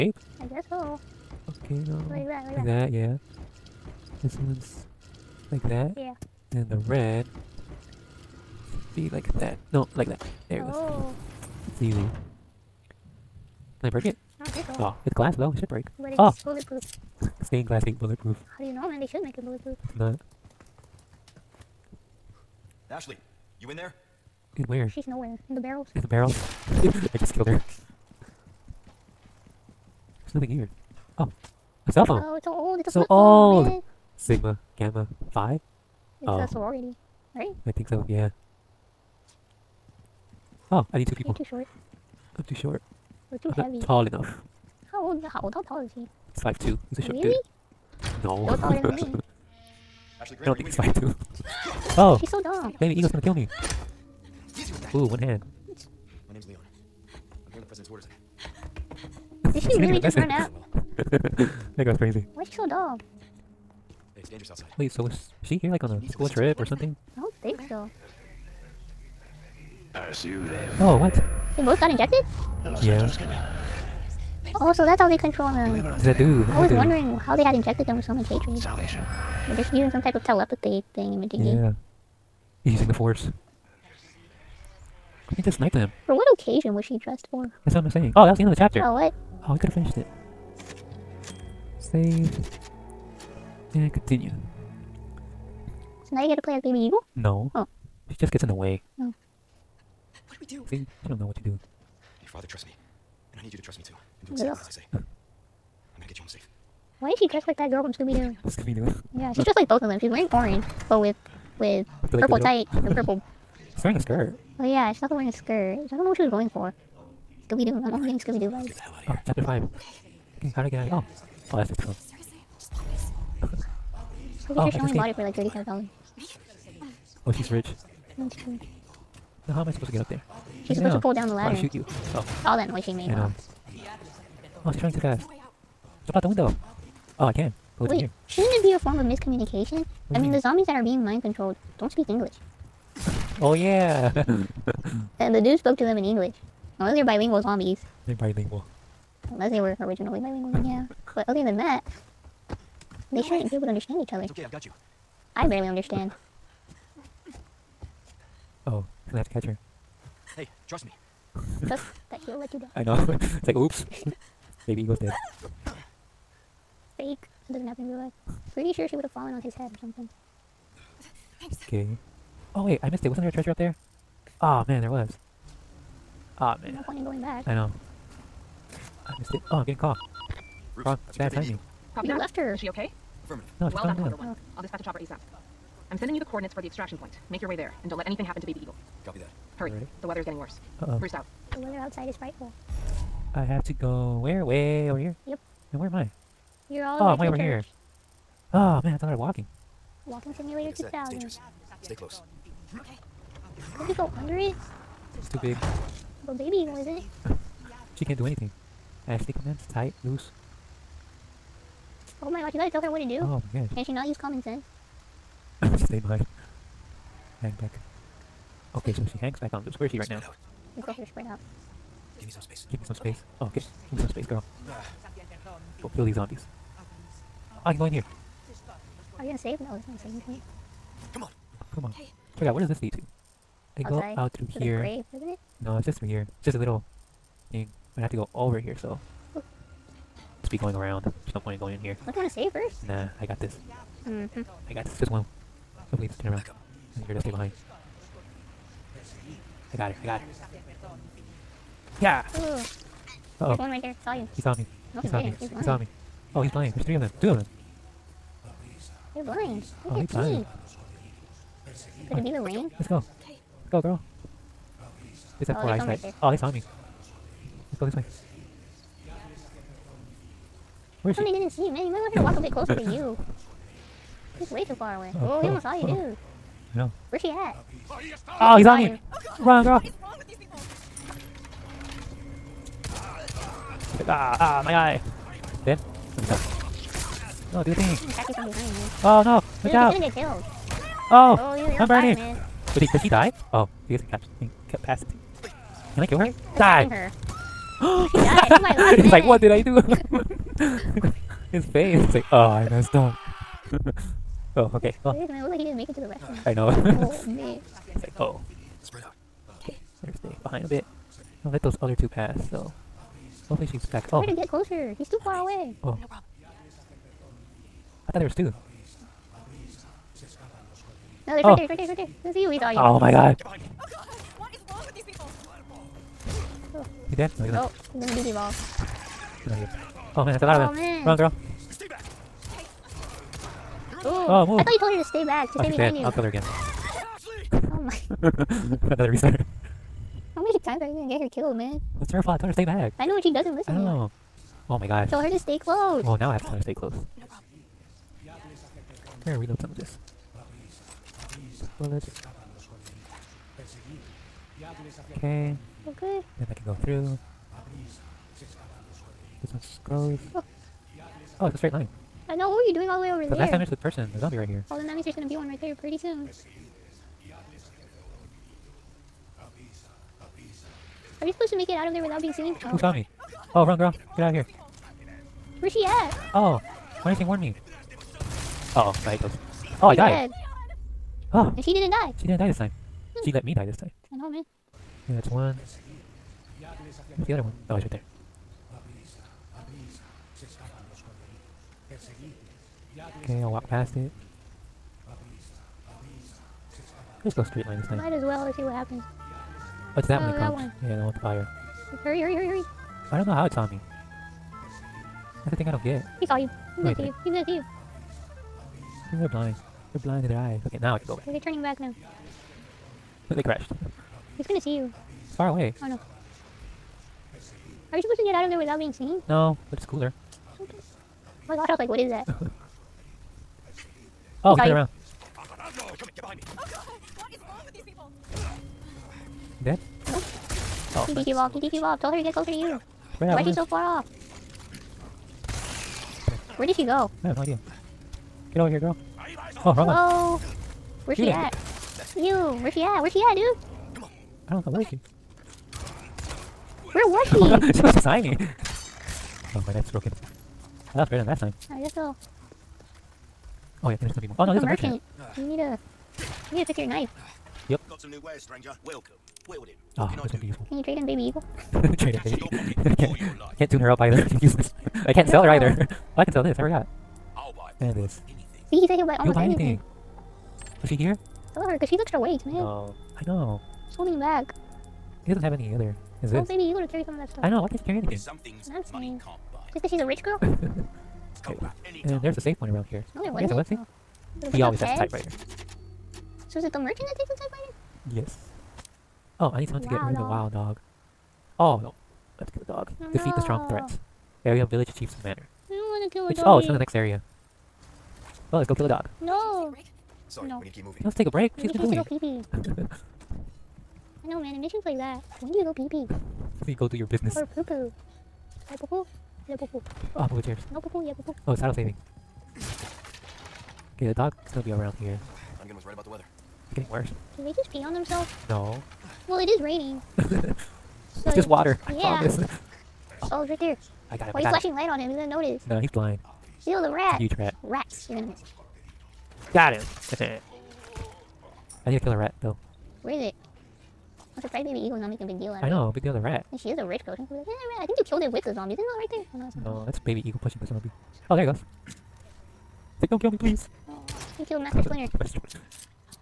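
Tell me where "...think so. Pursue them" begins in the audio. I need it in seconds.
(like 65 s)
67 s.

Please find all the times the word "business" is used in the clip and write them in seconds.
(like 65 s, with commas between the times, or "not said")
507 s.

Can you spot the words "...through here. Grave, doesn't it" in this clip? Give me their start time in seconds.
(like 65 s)
234 s.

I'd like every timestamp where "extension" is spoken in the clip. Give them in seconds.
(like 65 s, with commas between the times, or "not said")
not said.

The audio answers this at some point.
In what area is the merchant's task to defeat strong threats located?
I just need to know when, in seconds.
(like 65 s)
494 s.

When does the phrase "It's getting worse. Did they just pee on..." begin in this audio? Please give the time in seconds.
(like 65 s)
516 s.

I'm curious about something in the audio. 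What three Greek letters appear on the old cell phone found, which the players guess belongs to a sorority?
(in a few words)
Sigma Gamma Phi.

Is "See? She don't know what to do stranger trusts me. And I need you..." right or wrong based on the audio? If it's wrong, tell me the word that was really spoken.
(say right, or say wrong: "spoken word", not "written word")
wrong: "father", not "stranger".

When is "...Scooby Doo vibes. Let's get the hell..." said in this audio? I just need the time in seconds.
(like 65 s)
118 s.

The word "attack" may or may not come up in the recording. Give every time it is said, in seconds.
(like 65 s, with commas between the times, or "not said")
288 s.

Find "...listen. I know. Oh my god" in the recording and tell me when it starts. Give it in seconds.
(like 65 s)
343 s.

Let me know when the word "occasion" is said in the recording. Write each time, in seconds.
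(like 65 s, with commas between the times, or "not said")
86 s.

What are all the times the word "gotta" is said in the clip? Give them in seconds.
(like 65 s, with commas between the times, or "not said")
212 s, 476 s.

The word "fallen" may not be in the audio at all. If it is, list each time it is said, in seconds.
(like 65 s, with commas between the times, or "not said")
169 s.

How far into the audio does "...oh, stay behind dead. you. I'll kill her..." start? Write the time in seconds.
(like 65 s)
335 s.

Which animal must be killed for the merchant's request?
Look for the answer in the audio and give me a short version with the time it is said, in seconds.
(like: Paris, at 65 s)
wild dog, at 490 s.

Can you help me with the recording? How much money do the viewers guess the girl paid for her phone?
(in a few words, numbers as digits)
$35.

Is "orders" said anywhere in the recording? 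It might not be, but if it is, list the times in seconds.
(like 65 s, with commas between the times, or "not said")
57 s.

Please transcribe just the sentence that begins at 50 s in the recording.
Ashley I don't think he's five two.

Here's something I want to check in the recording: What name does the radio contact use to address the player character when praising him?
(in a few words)
Conquer One.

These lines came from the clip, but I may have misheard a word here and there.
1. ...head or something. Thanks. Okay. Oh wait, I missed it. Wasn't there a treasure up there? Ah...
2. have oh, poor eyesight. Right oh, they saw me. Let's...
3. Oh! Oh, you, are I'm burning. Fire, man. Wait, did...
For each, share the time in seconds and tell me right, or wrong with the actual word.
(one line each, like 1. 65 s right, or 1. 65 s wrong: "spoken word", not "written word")
1. 169 s right
2. 265 s right
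3. 291 s right.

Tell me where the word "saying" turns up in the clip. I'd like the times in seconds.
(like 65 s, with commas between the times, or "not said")
87 s, 479 s.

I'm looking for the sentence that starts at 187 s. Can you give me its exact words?
Make your way there, and don't let anything happen to Baby Eagle.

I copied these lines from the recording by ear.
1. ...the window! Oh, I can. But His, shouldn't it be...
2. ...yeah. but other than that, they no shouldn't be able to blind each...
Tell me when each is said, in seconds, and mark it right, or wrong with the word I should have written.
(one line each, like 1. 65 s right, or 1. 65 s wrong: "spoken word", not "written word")
1. 136 s wrong: "Wait", not "His"
2. 150 s wrong: "understand", not "blind".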